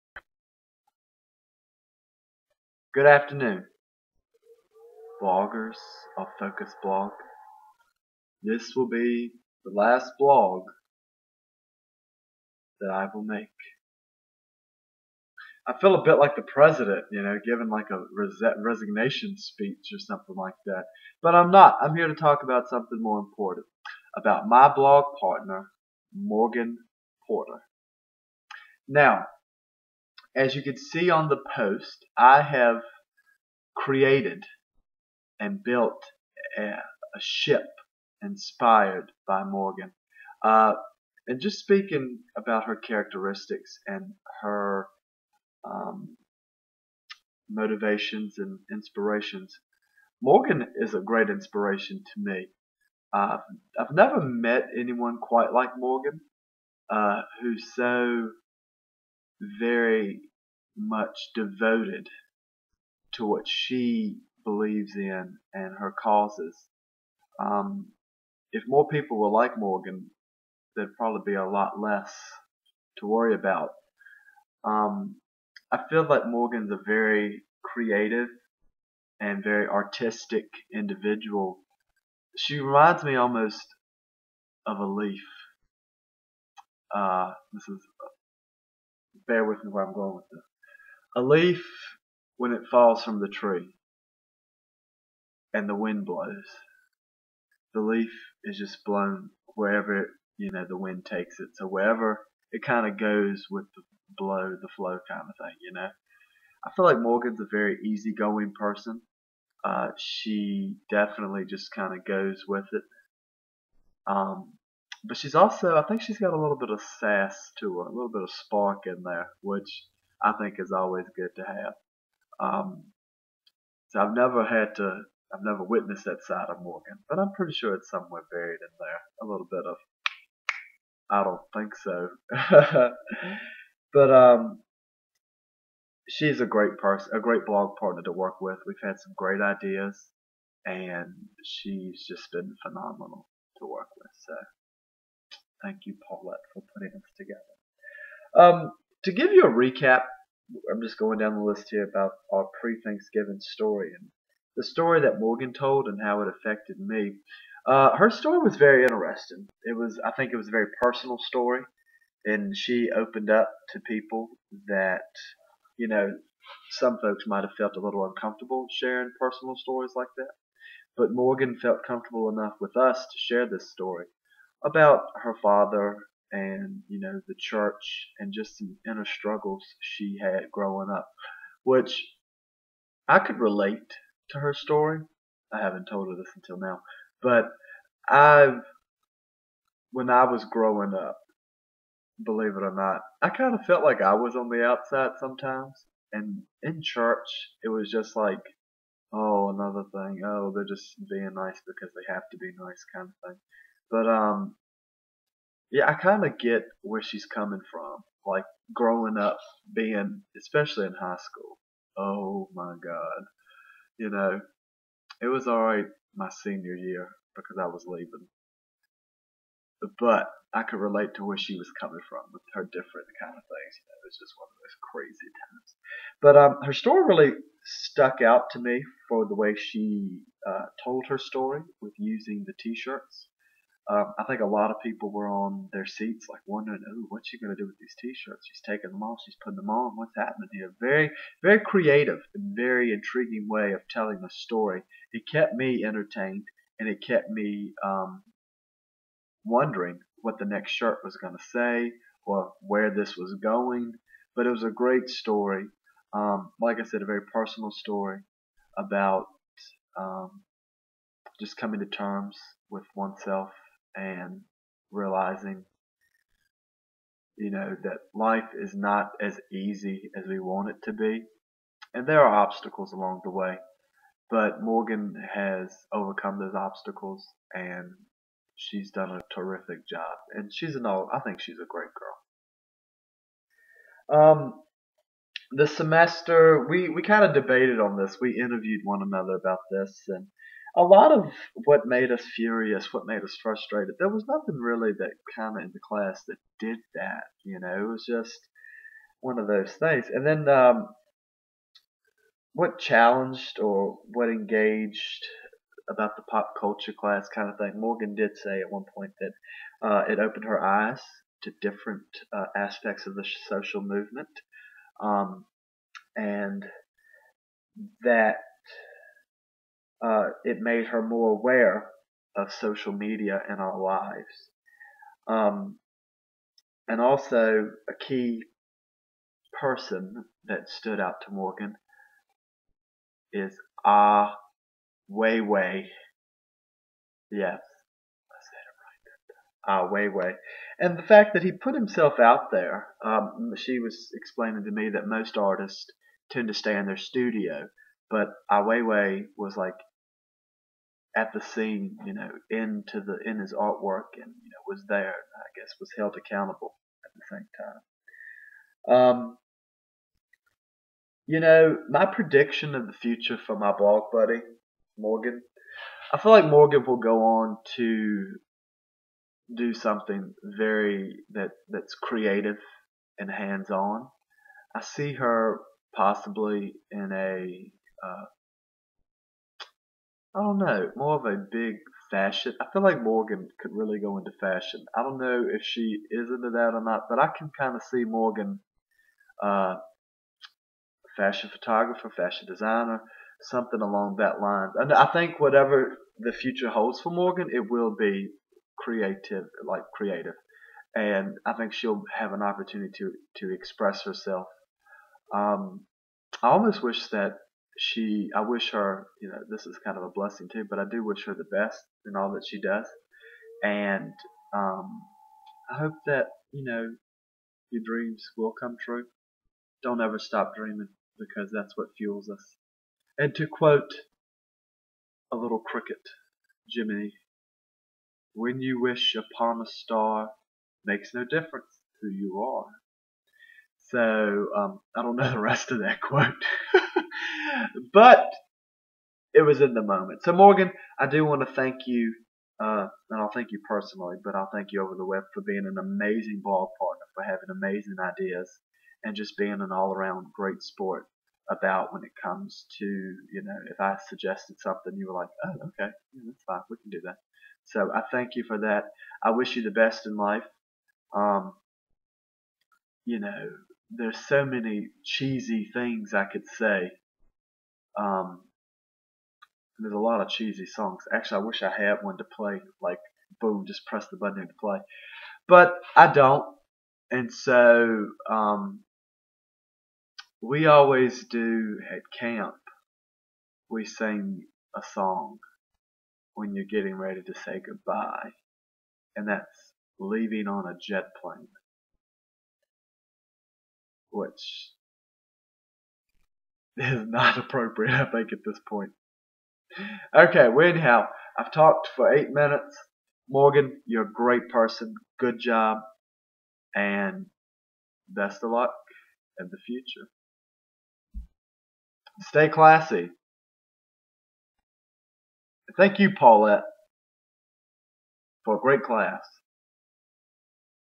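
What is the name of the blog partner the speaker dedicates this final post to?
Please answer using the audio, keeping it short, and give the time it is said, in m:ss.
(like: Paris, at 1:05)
Morgan Porter, at 0:26.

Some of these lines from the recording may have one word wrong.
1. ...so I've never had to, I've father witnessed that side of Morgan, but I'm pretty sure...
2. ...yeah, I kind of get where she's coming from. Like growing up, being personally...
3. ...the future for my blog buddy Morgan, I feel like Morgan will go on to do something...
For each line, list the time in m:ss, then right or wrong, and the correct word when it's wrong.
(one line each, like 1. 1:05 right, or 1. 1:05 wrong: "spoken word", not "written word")
1. 2:03 wrong: "never", not "father"
2. 3:25 wrong: "especially", not "personally"
3. 6:02 right.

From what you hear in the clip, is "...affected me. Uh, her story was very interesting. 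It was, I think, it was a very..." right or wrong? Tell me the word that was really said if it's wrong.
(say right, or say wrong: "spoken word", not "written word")
right.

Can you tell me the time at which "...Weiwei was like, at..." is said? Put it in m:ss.
5:48.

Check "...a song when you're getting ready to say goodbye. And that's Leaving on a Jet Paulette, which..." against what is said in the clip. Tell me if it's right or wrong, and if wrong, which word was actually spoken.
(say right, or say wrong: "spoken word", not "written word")
wrong: "Plane", not "Paulette".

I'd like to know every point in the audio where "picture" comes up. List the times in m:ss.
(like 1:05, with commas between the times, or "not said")
not said.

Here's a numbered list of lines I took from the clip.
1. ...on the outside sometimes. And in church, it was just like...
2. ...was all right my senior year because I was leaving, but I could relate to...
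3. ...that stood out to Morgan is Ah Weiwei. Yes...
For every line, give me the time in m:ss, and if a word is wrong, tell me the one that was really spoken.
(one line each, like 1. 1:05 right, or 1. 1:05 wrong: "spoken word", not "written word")
1. 3:14 right
2. 3:35 right
3. 5:30 right.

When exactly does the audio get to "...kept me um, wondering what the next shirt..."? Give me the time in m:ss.
4:07.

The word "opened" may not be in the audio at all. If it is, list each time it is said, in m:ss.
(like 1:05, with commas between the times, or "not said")
2:42, 5:10.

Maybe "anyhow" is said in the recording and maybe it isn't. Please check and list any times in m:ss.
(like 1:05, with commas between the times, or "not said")
8:20.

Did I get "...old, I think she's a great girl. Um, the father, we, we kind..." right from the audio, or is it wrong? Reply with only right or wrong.
wrong.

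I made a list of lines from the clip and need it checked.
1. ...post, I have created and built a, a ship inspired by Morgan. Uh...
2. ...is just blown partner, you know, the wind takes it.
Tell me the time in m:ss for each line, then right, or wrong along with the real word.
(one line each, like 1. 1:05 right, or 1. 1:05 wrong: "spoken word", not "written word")
1. 0:31 right
2. 1:38 wrong: "wherever", not "partner".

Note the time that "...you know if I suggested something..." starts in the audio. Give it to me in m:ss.
7:32.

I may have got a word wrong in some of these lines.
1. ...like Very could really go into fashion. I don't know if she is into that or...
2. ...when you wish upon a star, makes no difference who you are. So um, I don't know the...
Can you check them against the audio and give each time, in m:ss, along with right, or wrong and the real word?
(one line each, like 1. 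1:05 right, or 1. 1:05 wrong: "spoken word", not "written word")
1. 6:22 wrong: "Morgan", not "Very"
2. 7:08 right.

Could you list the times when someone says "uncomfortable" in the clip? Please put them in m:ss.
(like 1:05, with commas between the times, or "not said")
2:48.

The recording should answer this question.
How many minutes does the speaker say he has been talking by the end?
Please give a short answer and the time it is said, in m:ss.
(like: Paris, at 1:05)
8, at 8:22.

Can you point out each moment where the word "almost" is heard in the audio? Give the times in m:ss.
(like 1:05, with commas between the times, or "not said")
1:23, 6:46.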